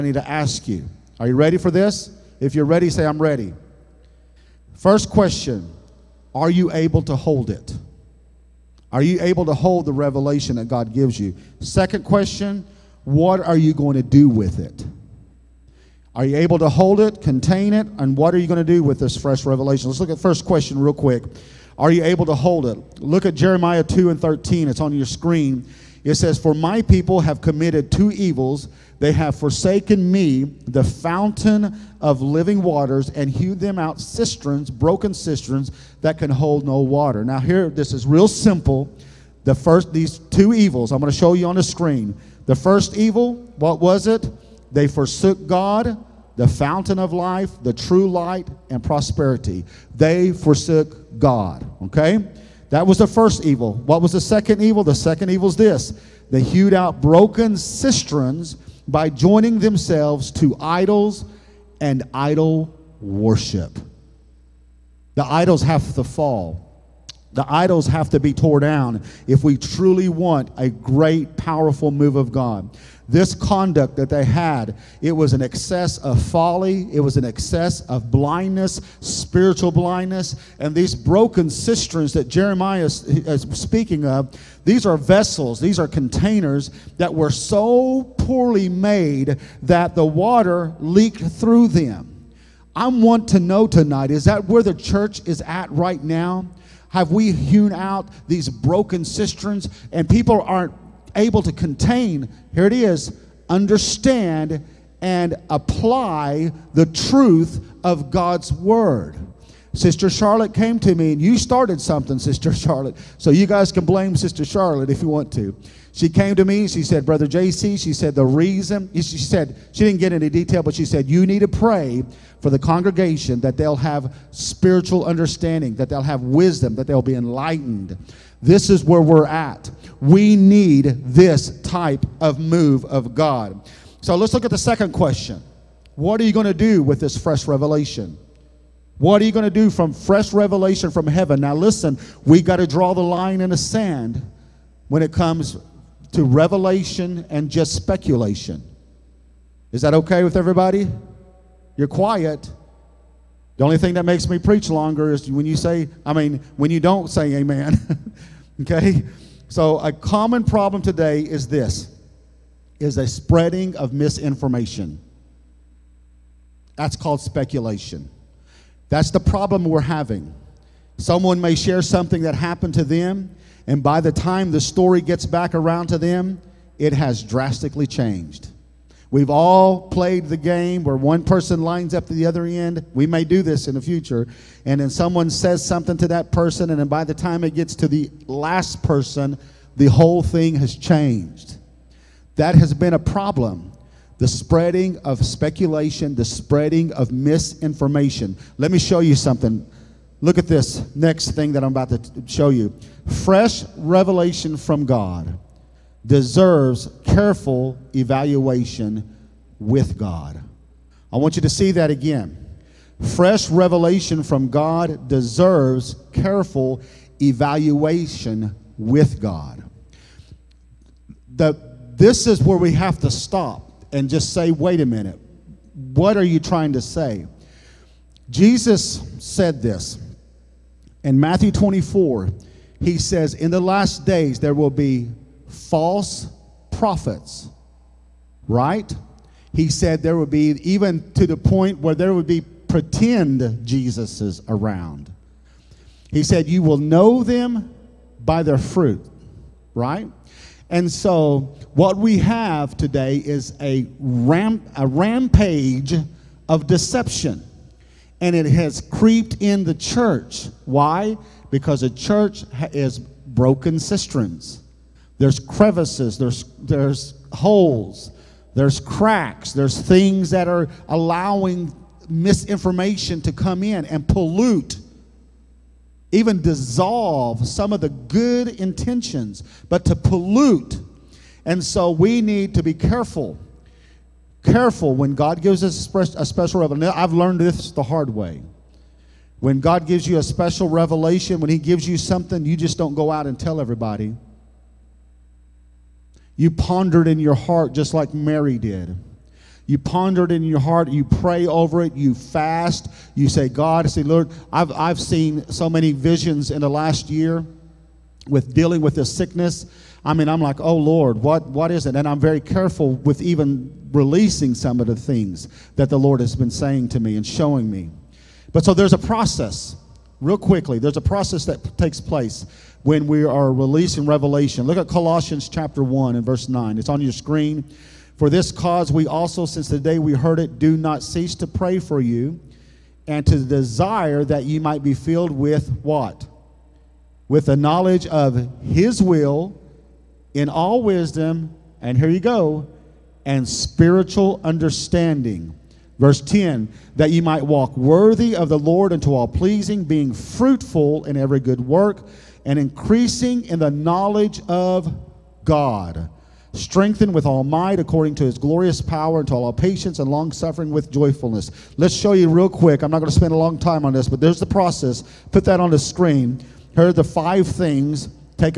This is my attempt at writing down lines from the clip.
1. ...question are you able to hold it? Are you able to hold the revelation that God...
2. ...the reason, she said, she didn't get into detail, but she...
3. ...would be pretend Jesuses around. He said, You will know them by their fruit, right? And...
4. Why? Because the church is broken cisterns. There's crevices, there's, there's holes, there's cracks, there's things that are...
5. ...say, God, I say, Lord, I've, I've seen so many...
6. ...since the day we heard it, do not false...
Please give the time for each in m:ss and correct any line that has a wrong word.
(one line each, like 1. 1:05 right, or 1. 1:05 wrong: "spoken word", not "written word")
1. 0:05 right
2. 1:58 right
3. 4:02 right
4. 4:20 right
5. 5:03 right
6. 5:29 wrong: "cease", not "false".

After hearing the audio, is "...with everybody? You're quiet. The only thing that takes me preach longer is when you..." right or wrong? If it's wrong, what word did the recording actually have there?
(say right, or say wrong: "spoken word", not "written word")
wrong: "makes", not "takes".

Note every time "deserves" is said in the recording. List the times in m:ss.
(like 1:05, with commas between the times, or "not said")
3:26, 3:35.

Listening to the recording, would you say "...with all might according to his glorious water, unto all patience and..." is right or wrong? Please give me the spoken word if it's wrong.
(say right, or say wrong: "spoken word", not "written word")
wrong: "power", not "water".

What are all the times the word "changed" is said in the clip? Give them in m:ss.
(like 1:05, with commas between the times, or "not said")
2:57, 3:10.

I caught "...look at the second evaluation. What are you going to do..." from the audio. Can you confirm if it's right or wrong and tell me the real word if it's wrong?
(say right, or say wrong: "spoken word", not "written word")
wrong: "question", not "evaluation".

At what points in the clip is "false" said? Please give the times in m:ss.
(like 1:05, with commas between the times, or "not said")
3:55.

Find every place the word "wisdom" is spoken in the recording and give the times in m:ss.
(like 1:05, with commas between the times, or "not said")
2:06, 5:40.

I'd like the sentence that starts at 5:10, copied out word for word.
I mean, I'm like, oh, Lord, what, what is it?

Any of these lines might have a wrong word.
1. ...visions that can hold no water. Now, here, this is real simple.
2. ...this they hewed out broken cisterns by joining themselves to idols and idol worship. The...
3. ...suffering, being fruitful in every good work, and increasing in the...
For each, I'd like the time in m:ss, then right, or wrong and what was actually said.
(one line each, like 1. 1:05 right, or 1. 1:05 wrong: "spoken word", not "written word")
1. 0:35 wrong: "cisterns", not "visions"
2. 0:55 right
3. 5:49 wrong: "pleasing", not "suffering".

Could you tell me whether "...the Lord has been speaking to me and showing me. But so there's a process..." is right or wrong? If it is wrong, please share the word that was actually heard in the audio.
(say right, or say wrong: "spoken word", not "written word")
wrong: "saying", not "speaking".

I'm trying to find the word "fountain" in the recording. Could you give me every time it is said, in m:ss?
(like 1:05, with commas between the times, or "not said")
0:30, 0:46.